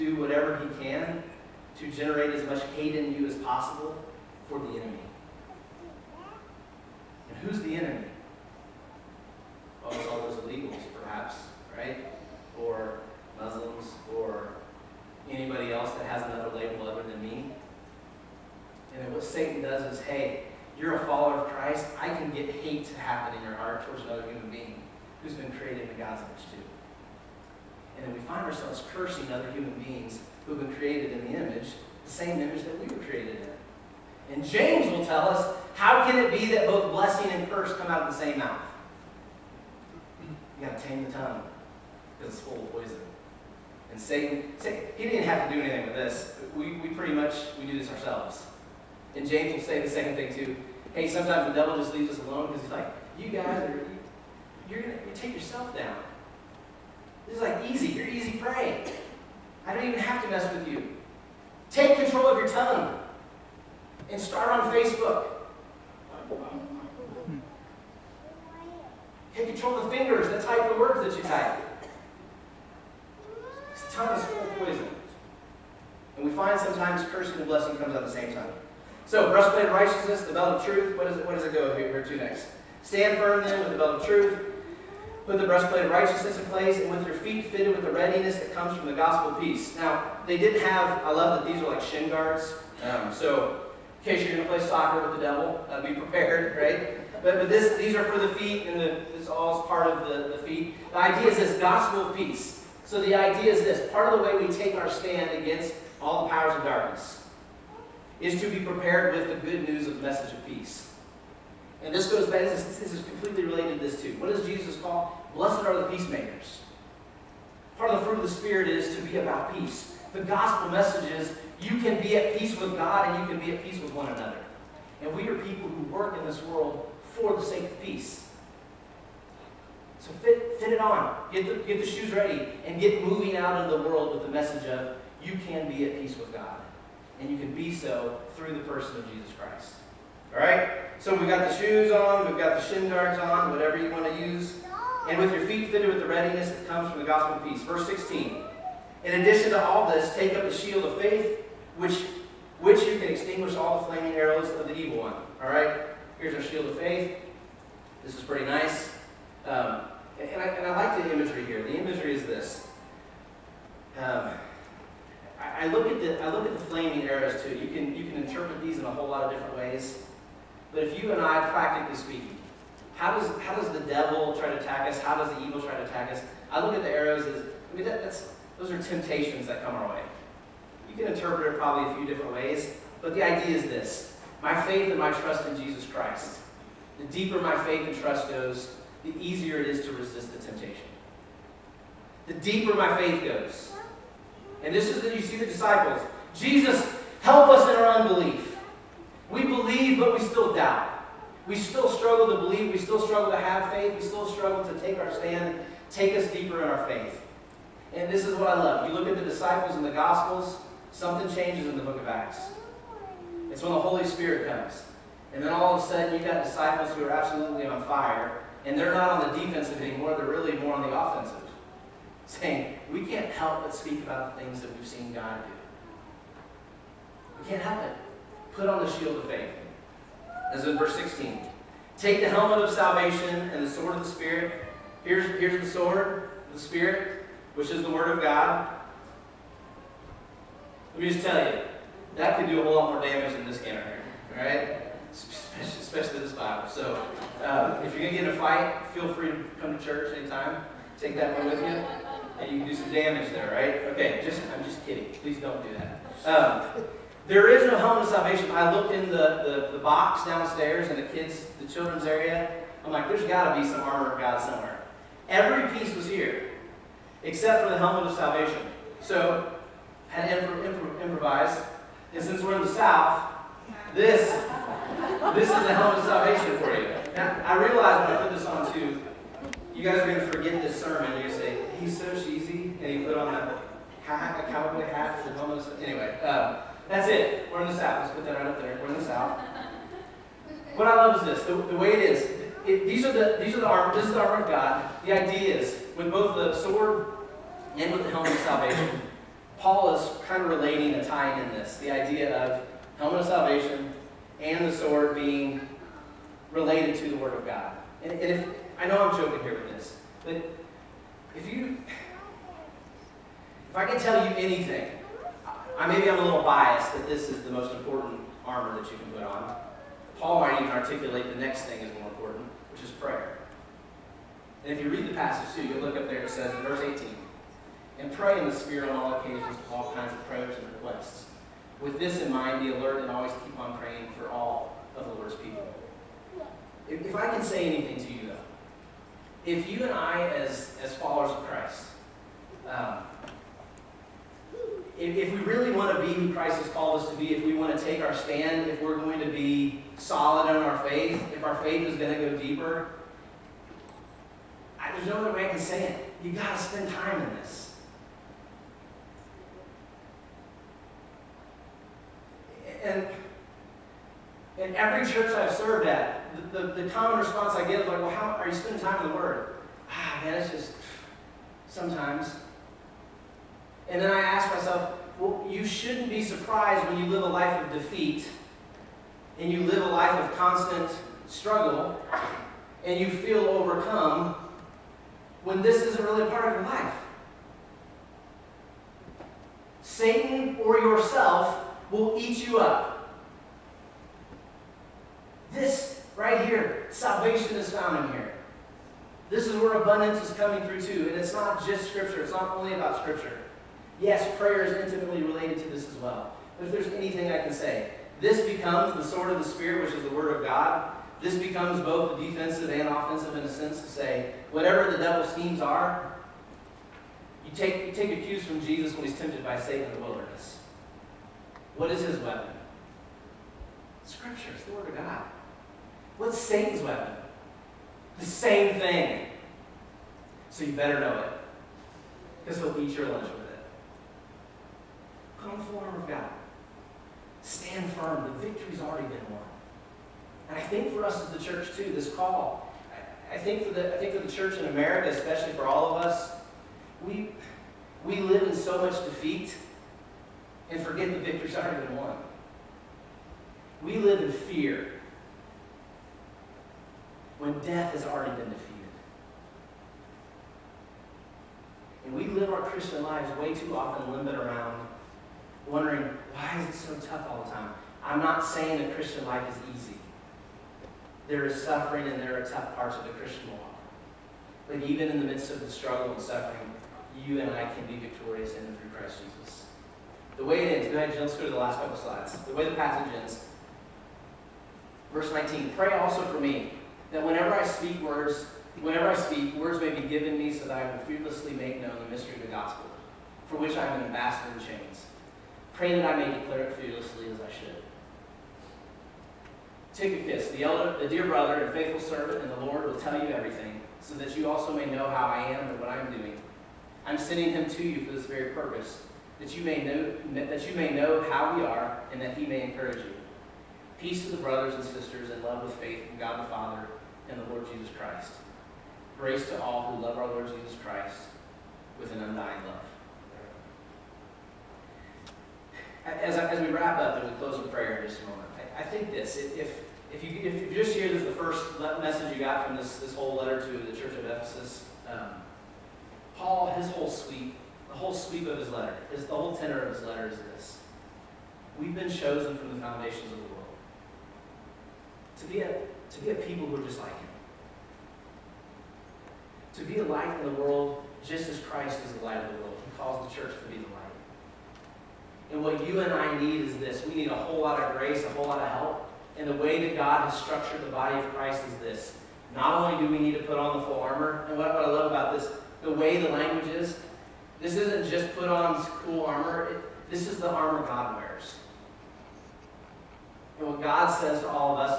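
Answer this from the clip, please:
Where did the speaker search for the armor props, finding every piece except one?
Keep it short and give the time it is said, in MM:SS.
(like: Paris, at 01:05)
the children's area, at 04:21.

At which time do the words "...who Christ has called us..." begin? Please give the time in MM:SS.
05:46.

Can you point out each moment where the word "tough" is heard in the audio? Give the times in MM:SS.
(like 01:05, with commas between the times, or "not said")
07:47, 07:52.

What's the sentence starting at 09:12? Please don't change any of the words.
He calls the church to be the light.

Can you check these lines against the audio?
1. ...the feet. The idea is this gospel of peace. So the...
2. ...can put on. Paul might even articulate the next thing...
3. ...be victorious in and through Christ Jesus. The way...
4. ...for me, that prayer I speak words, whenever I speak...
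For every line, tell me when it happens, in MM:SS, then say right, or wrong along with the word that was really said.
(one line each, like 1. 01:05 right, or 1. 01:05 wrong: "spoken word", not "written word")
1. 01:40 right
2. 05:18 right
3. 07:57 right
4. 08:06 wrong: "whenever", not "prayer".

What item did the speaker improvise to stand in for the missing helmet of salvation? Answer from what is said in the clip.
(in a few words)
a cowboy hat.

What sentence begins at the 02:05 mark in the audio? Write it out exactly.
And we are people who work in this world for the sake of peace.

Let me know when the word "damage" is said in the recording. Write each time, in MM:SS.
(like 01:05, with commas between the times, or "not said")
04:03, 04:12.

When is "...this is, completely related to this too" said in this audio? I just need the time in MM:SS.
01:52.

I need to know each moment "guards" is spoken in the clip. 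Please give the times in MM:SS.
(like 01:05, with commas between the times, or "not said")
01:32, 02:22.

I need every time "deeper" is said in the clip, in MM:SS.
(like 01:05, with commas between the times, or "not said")
03:07, 03:12, 03:26, 05:52.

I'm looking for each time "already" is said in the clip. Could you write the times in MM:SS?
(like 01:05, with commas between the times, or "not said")
07:18, 07:31, 07:38.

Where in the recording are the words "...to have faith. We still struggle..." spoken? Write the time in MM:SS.
03:23.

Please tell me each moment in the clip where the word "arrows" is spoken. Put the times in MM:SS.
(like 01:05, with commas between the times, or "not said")
02:34, 02:47, 02:56.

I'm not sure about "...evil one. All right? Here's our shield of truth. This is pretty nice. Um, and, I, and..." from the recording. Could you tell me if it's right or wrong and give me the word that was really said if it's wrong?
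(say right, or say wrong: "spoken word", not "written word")
wrong: "faith", not "truth".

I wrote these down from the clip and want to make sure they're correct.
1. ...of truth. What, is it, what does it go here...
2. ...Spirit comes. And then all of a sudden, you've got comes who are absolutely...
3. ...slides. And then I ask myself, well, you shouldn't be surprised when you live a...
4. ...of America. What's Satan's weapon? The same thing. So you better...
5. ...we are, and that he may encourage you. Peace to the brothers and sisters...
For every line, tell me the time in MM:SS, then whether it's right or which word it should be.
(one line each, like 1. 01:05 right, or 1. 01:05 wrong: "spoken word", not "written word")
1. 01:20 right
2. 03:34 wrong: "disciples", not "comes"
3. 06:11 wrong: "sometimes", not "slides"
4. 07:04 wrong: "God", not "America"
5. 08:31 right.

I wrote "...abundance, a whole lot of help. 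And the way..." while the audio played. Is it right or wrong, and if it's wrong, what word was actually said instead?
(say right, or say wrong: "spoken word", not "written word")
wrong: "grace", not "abundance".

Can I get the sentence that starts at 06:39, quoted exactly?
This is where abundance is coming through too.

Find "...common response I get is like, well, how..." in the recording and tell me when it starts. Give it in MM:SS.
06:06.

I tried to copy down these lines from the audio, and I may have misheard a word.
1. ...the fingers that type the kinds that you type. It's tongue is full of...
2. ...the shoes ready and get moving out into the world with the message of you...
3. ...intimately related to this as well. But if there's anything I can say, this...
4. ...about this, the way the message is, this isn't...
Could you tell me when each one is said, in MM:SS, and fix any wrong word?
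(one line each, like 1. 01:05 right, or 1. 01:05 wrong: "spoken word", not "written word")
1. 01:09 wrong: "words", not "kinds"
2. 02:11 right
3. 06:44 right
4. 09:25 wrong: "language", not "message".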